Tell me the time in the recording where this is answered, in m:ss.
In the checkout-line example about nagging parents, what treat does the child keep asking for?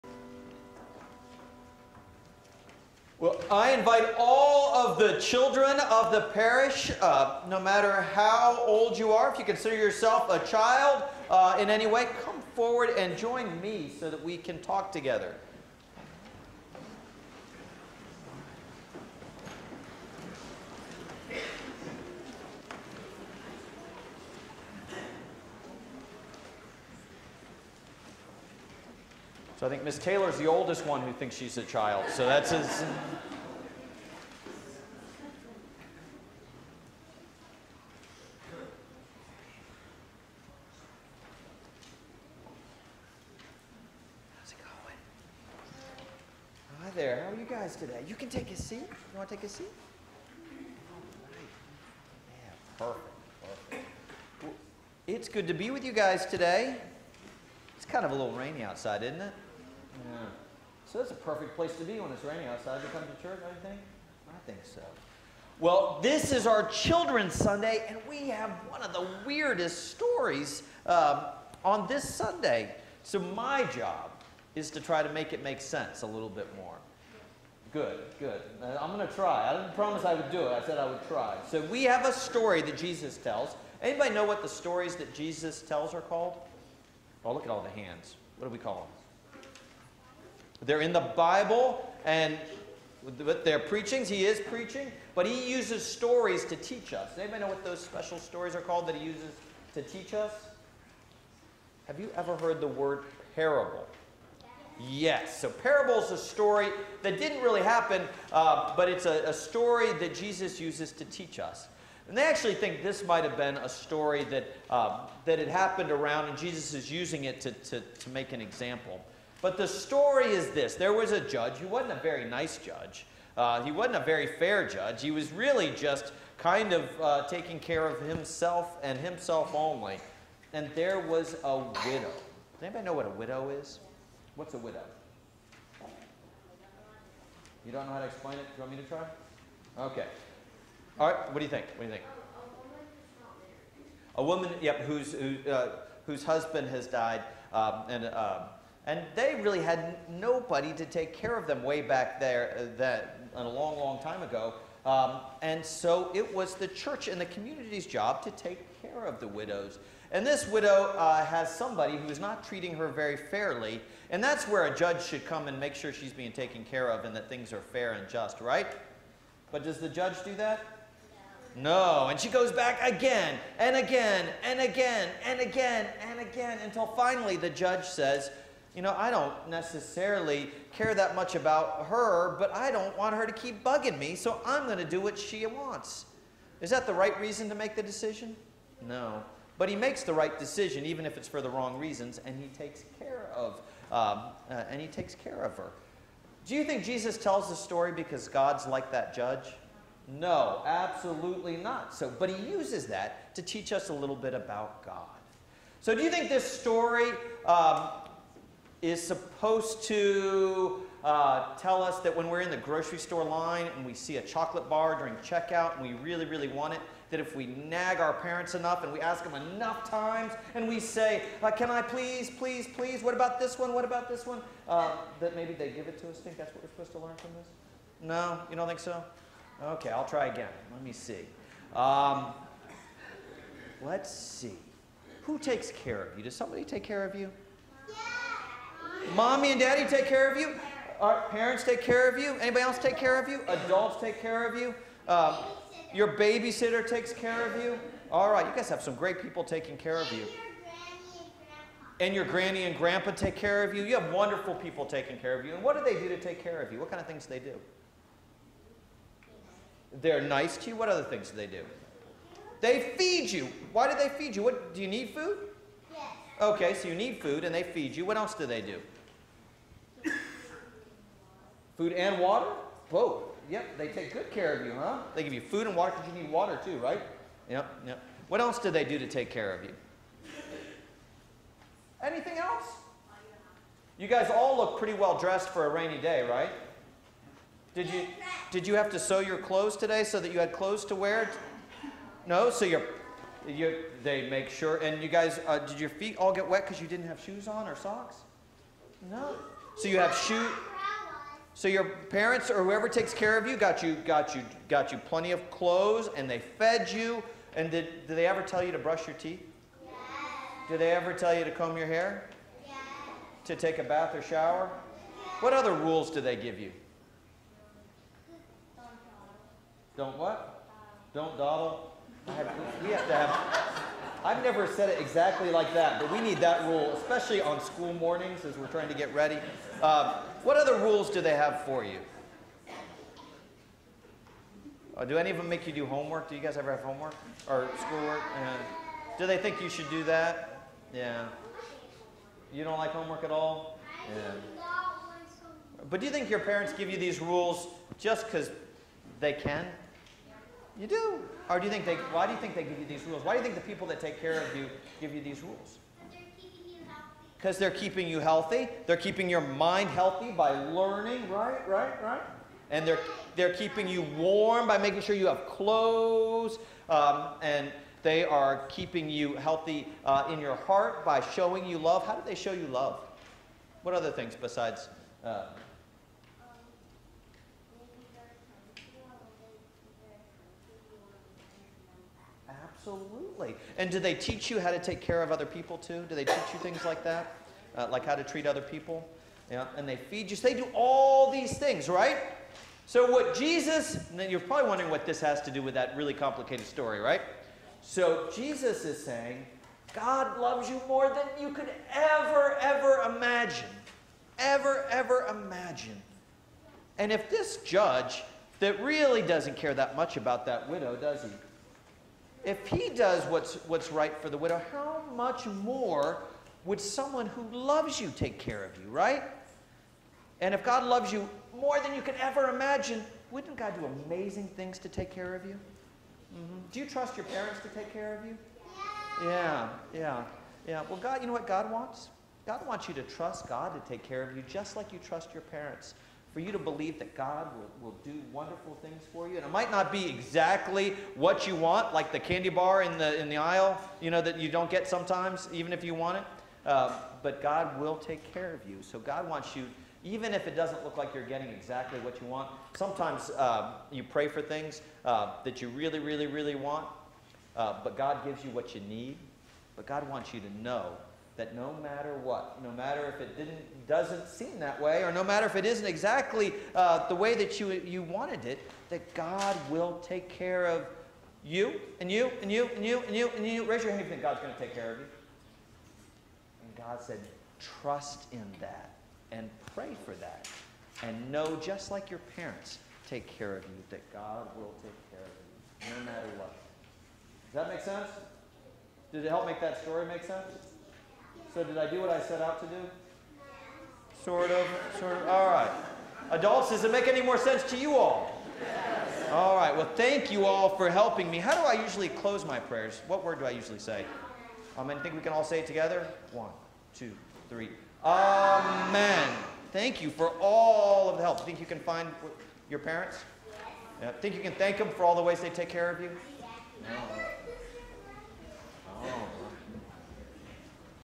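3:34.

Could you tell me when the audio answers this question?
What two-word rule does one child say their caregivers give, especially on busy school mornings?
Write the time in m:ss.
5:21.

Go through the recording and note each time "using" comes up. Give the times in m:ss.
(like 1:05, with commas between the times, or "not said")
1:56.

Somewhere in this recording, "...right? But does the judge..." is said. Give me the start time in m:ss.
2:48.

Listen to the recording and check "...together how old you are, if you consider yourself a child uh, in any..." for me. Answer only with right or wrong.
wrong.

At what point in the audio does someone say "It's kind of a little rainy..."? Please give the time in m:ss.
0:57.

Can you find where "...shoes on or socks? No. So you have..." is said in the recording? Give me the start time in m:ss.
4:57.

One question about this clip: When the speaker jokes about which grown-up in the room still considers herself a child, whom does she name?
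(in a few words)
Miss Taylor.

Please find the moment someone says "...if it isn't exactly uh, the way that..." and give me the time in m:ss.
7:45.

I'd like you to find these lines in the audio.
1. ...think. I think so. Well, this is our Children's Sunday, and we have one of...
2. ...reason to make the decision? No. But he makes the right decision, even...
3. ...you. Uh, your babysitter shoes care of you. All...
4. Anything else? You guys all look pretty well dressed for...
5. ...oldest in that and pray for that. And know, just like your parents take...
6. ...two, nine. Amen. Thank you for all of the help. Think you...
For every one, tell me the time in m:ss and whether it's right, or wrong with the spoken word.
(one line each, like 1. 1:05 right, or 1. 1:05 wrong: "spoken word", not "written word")
1. 1:03 right
2. 3:07 right
3. 4:04 wrong: "takes", not "shoes"
4. 4:42 right
5. 7:57 wrong: "trust", not "oldest"
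6. 8:26 wrong: "three", not "nine".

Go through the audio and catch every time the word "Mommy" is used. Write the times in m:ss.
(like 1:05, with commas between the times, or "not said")
3:59.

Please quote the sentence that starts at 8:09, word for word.
Did it help make that story make sense?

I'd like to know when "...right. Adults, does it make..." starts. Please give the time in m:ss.
8:15.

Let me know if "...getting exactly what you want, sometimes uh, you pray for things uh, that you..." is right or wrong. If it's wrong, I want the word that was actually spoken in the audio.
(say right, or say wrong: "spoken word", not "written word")
right.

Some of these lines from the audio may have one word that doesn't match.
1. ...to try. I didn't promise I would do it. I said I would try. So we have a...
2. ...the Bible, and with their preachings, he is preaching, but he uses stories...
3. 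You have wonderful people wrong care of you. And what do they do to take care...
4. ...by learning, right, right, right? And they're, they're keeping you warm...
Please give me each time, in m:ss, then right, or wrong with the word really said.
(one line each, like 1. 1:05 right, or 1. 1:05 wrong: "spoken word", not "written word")
1. 1:19 right
2. 1:30 right
3. 4:13 wrong: "taking", not "wrong"
4. 6:00 right.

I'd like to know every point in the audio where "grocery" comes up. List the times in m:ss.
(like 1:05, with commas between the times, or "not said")
3:32.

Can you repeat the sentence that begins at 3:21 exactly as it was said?
So, but he uses that to teach us a little bit about God.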